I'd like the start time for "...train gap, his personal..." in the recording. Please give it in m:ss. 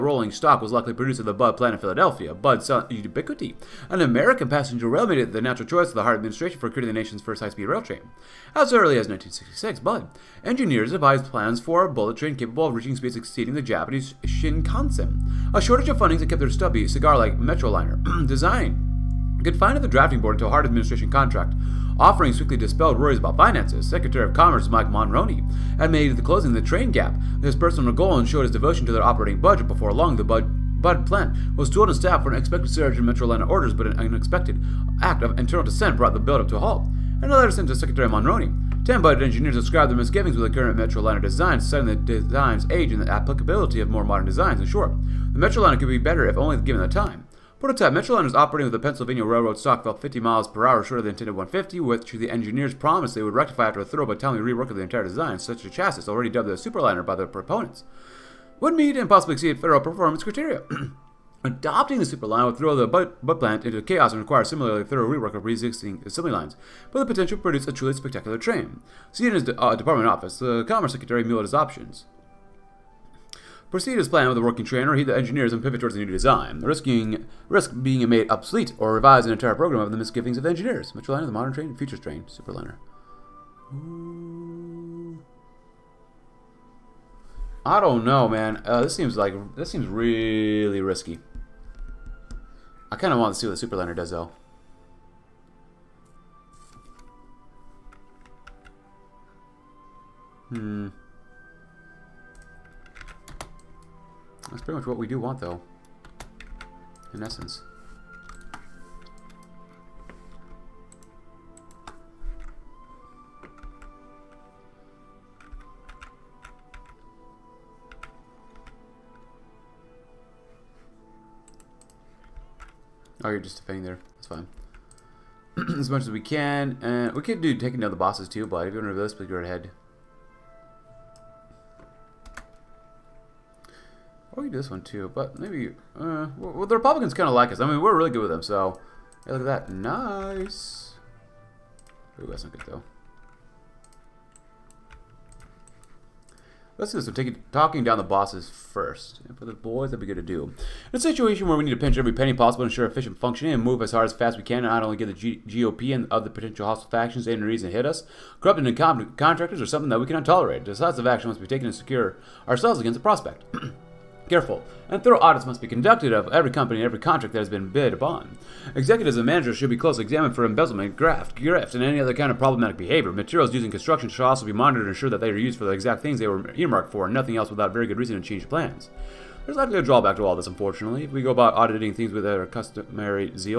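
0:26.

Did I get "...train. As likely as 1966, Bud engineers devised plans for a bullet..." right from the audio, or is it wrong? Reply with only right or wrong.
wrong.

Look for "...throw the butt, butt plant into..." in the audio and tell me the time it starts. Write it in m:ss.
1:02.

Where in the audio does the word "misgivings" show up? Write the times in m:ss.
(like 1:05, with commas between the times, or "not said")
0:39, 1:19.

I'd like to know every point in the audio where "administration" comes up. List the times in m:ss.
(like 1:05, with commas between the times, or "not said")
0:06, 0:20.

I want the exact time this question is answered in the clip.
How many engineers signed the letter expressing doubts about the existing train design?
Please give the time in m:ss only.
0:38.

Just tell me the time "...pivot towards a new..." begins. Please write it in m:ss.
1:15.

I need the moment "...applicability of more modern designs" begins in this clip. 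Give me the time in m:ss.
0:43.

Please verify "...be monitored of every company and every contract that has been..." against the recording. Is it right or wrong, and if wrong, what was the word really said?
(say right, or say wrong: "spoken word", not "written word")
wrong: "conducted", not "monitored".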